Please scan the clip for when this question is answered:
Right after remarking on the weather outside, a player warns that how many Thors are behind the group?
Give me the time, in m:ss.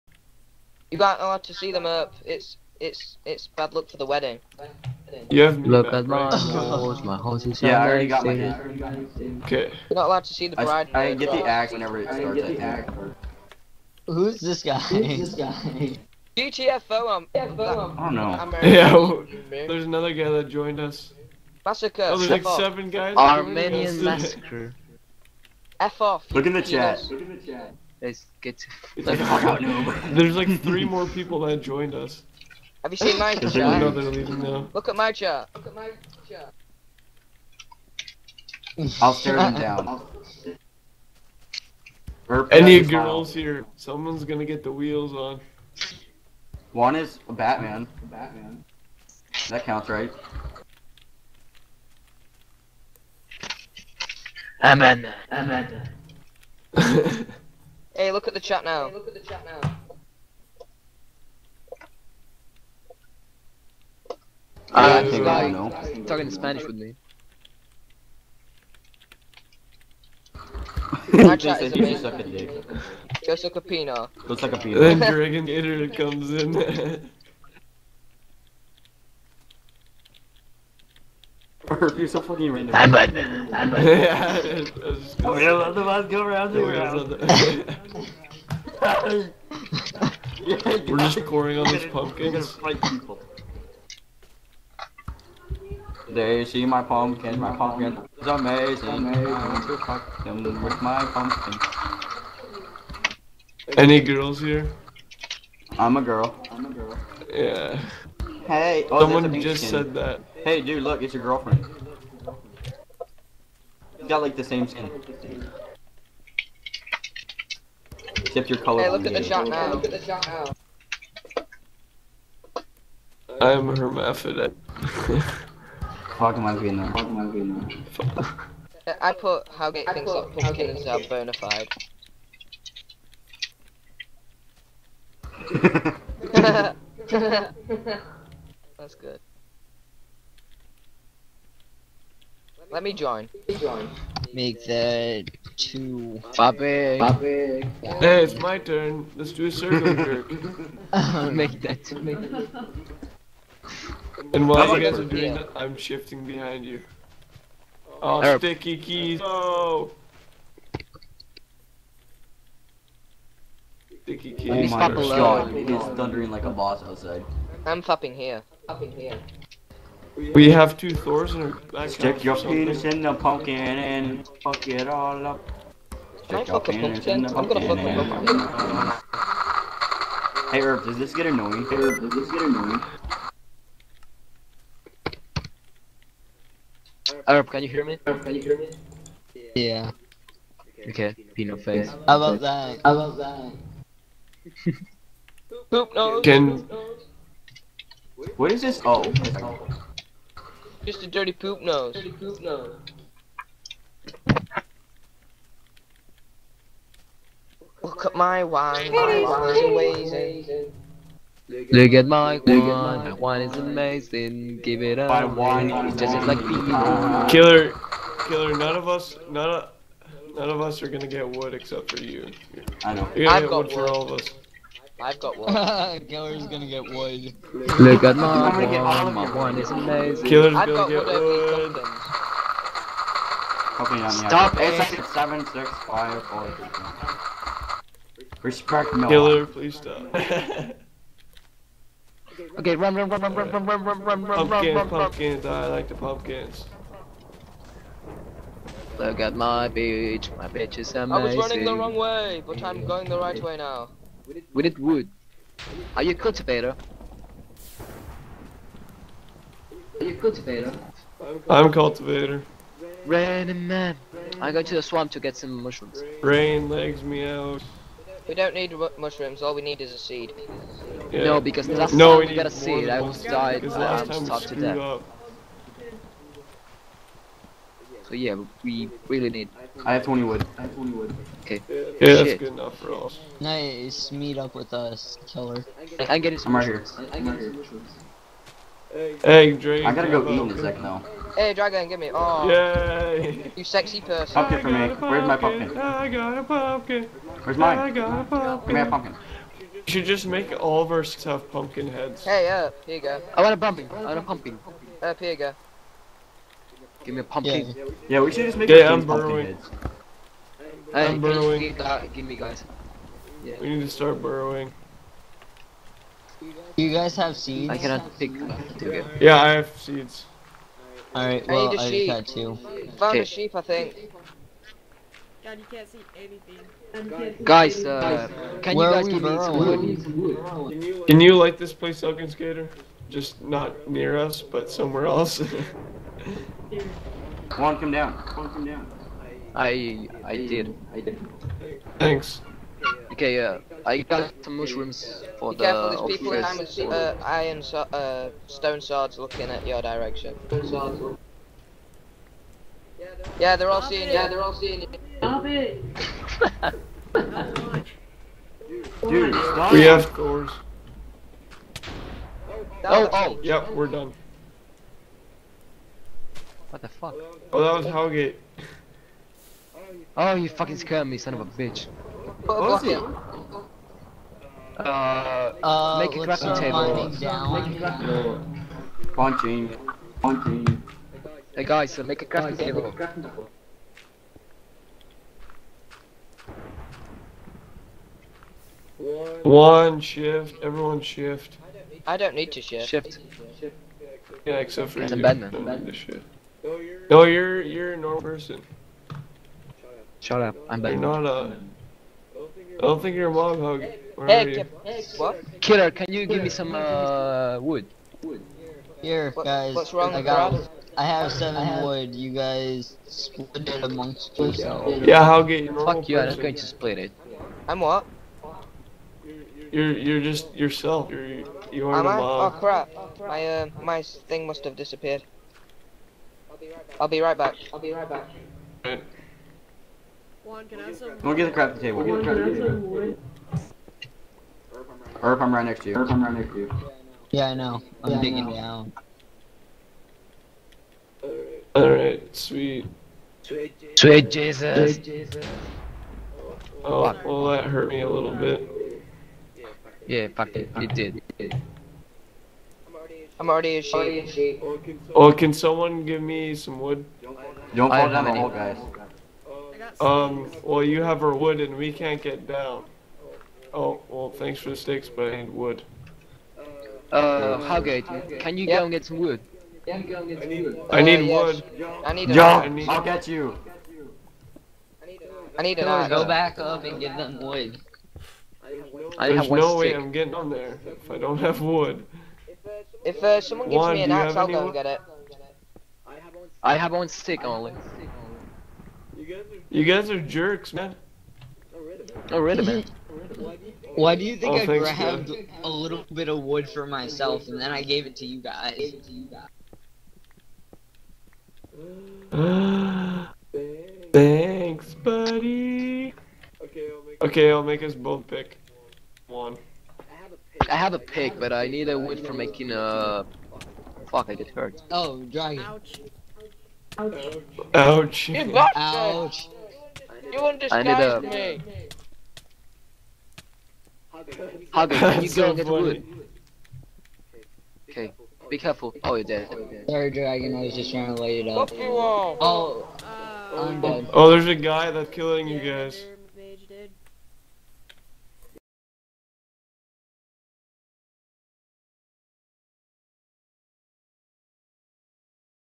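2:50.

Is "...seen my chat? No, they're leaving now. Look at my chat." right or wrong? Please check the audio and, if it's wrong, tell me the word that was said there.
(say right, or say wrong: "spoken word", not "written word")
right.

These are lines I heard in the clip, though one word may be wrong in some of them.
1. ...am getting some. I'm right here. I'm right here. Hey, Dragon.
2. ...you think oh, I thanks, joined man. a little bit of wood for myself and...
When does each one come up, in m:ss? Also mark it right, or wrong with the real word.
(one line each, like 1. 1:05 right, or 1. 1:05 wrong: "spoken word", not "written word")
1. 4:46 right
2. 8:14 wrong: "grabbed", not "joined".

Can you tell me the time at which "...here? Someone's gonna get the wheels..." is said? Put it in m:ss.
0:43.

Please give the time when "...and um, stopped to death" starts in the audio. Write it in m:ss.
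4:33.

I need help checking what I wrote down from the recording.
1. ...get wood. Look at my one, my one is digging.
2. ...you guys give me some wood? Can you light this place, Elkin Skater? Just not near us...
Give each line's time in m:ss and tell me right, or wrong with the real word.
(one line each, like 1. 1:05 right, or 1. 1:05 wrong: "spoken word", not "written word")
1. 3:46 wrong: "amazing", not "digging"
2. 5:28 right.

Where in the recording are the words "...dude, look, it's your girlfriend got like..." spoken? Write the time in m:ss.
1:50.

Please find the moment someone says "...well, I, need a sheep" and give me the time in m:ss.
5:21.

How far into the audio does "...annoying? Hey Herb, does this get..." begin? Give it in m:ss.
3:01.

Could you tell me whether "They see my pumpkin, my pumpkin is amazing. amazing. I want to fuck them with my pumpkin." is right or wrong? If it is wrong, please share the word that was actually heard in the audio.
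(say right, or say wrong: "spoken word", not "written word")
right.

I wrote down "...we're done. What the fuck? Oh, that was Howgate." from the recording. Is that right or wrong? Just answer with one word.
right.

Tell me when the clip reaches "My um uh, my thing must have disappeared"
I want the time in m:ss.
7:03.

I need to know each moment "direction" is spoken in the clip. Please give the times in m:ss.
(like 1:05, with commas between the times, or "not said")
5:49.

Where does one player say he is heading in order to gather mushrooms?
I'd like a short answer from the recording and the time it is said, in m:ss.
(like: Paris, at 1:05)
The swamp, at 4:24.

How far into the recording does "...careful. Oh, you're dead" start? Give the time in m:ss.
8:48.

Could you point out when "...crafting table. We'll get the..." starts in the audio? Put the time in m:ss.
7:11.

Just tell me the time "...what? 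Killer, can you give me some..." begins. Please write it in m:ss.
6:45.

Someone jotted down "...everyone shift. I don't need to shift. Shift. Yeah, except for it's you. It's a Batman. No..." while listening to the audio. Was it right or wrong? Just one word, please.
right.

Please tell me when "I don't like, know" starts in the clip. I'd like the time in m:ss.
1:04.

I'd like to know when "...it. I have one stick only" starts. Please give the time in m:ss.
8:04.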